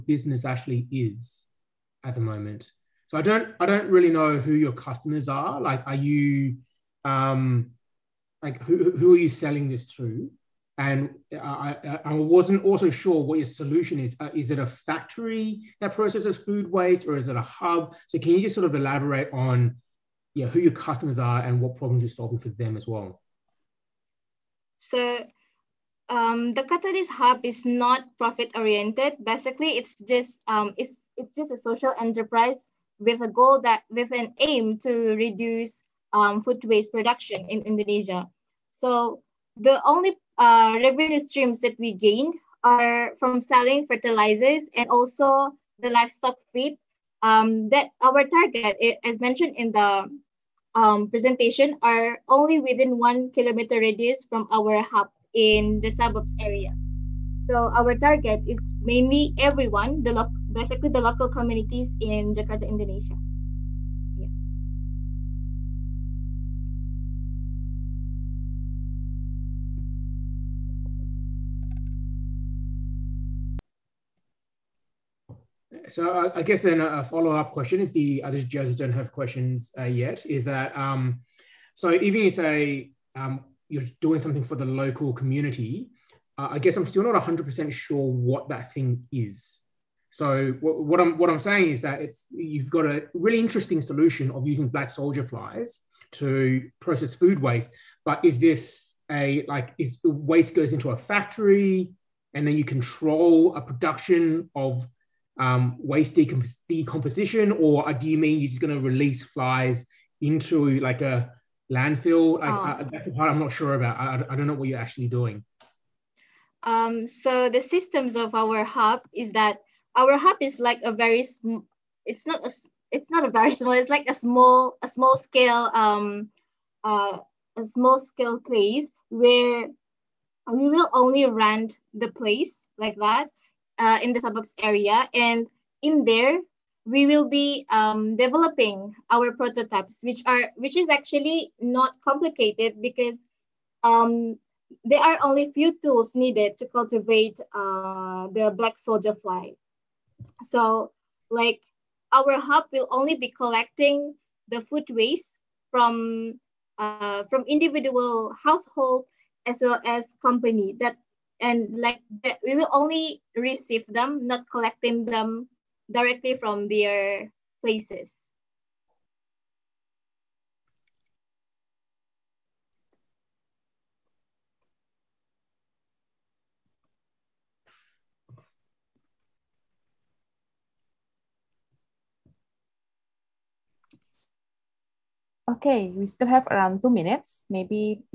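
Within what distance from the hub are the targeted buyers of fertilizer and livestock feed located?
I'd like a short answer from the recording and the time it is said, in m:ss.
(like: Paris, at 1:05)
1 kilometer radius, at 0:52.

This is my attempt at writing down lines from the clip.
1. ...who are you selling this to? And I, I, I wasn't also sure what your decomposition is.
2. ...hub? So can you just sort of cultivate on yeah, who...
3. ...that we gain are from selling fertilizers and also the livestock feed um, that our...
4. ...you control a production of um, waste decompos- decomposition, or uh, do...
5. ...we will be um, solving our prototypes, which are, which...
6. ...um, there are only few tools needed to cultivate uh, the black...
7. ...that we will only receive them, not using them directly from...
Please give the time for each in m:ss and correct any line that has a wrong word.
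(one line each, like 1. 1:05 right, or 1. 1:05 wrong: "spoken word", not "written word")
1. 0:08 wrong: "solution", not "decomposition"
2. 0:17 wrong: "elaborate", not "cultivate"
3. 0:41 right
4. 1:42 right
5. 2:16 wrong: "developing", not "solving"
6. 2:23 right
7. 2:42 wrong: "collecting", not "using".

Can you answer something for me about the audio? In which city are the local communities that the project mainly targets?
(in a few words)
Jakarta.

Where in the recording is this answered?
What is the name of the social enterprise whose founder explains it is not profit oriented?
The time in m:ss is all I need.
0:26.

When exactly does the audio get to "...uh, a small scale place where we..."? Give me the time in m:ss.
2:06.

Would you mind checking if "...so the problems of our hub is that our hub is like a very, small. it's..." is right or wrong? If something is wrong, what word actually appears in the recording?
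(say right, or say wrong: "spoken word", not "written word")
wrong: "systems", not "problems".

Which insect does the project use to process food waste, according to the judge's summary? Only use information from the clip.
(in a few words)
black soldier flies.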